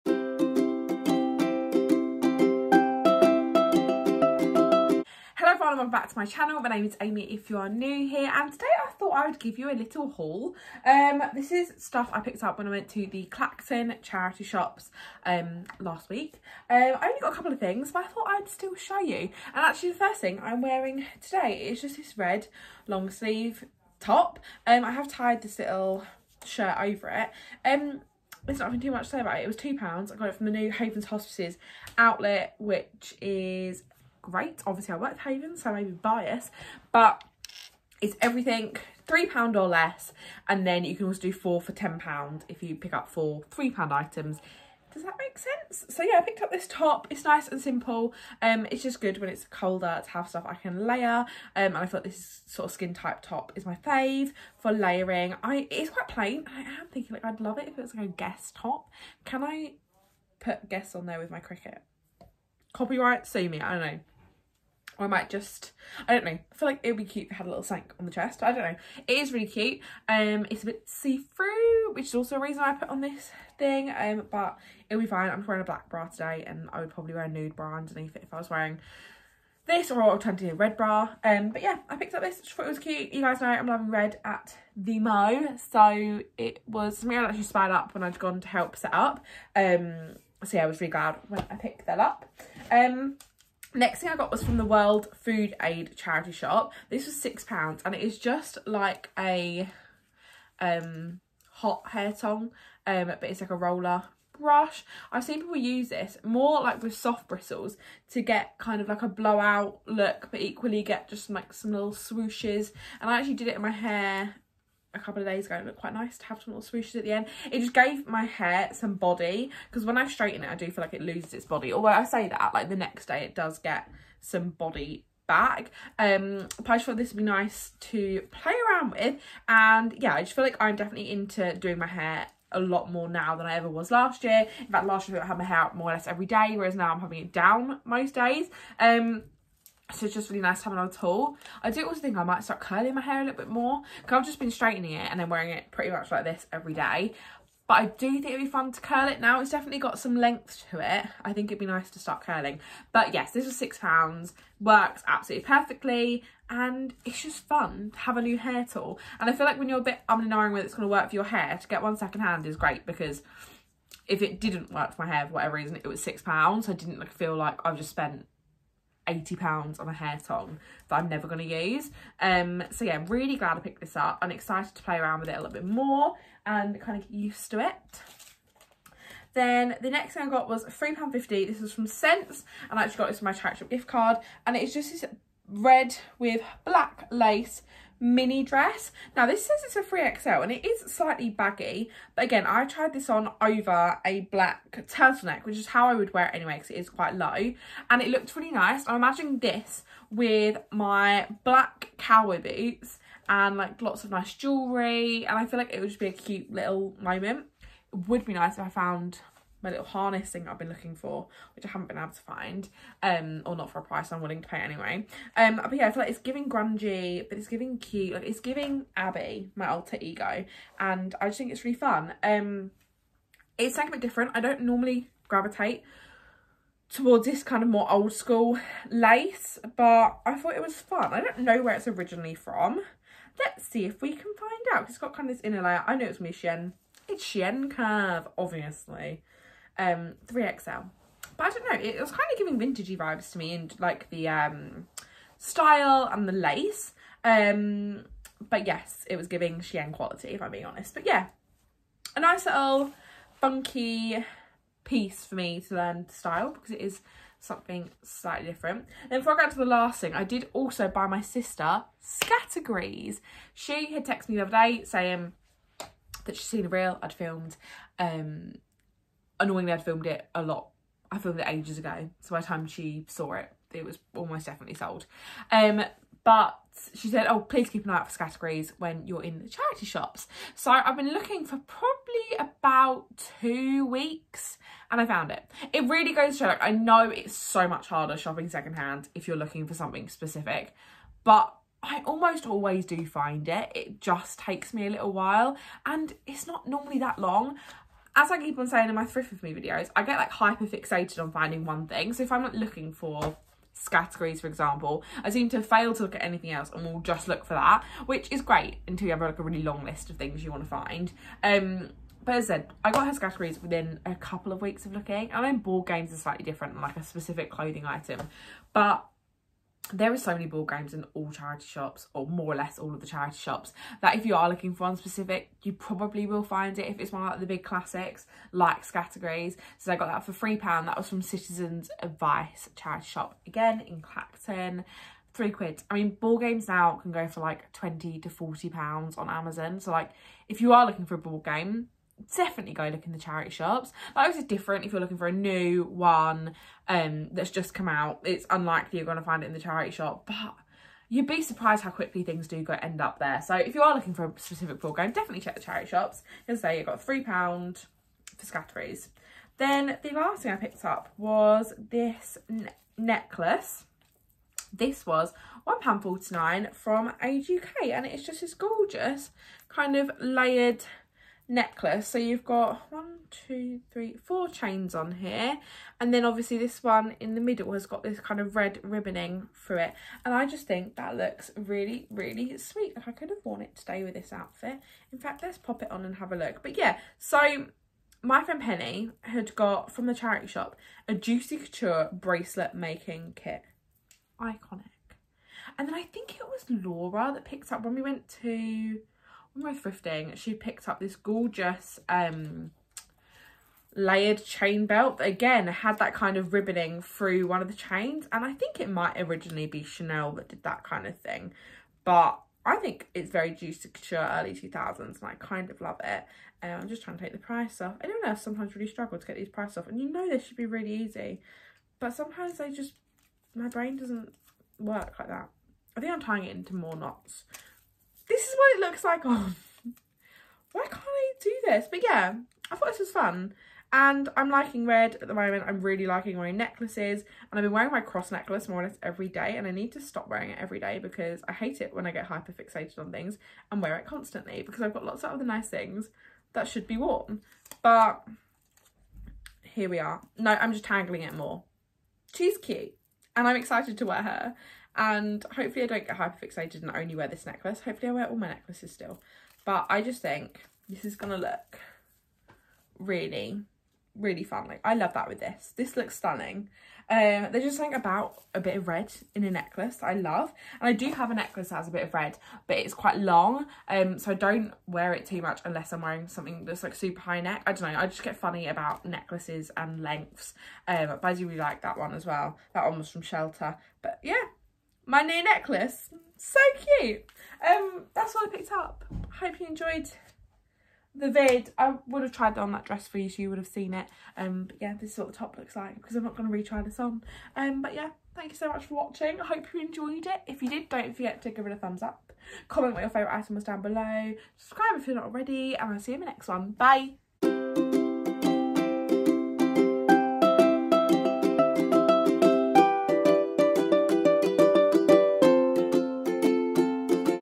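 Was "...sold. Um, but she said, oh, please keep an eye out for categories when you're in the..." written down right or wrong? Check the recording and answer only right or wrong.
right.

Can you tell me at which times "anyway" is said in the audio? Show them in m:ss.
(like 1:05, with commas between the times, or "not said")
3:16, 3:34.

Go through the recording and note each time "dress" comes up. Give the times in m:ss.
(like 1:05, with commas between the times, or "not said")
3:08, 8:12.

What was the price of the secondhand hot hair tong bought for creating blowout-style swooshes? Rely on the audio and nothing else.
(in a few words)
£6.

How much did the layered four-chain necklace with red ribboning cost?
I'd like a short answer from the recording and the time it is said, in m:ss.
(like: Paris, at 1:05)
£1.49, at 6:05.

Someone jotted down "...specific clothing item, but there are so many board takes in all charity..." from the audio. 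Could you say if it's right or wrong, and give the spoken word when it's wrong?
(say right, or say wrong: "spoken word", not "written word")
wrong: "games", not "takes".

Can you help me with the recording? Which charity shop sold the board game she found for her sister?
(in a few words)
Citizens Advice.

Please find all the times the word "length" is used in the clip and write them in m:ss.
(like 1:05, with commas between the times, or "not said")
2:30, 8:00.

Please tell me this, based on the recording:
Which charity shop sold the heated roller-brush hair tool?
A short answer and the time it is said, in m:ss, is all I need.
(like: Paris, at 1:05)
World Food Aid, at 1:34.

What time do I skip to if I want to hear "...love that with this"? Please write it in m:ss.
7:44.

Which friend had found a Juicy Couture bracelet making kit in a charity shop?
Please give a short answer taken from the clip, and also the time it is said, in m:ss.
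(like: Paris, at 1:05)
Penny, at 6:28.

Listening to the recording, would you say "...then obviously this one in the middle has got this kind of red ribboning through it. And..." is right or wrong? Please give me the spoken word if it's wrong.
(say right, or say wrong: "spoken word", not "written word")
right.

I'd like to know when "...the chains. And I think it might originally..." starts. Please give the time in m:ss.
6:47.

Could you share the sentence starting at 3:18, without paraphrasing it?
I'm imagining this with my black cowboy boots and like lots of nice jewellery.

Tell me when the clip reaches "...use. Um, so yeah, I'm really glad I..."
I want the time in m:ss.
2:51.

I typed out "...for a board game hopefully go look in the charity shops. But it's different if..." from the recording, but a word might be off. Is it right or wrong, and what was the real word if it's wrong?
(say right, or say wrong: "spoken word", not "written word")
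wrong: "definitely", not "hopefully".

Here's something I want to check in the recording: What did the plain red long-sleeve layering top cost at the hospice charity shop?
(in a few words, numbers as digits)
£2.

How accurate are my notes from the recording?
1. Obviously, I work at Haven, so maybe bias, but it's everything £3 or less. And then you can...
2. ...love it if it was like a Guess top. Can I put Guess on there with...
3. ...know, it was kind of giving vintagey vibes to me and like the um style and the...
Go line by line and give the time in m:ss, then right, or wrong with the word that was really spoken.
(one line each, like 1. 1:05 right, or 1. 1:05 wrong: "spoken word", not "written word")
1. 0:34 right
2. 0:57 right
3. 4:01 right.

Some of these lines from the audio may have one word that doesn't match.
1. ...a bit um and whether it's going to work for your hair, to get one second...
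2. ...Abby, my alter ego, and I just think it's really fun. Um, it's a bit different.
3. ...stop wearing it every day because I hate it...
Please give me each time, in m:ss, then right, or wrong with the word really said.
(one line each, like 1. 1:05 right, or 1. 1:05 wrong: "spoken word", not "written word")
1. 2:39 right
2. 3:38 right
3. 7:20 right.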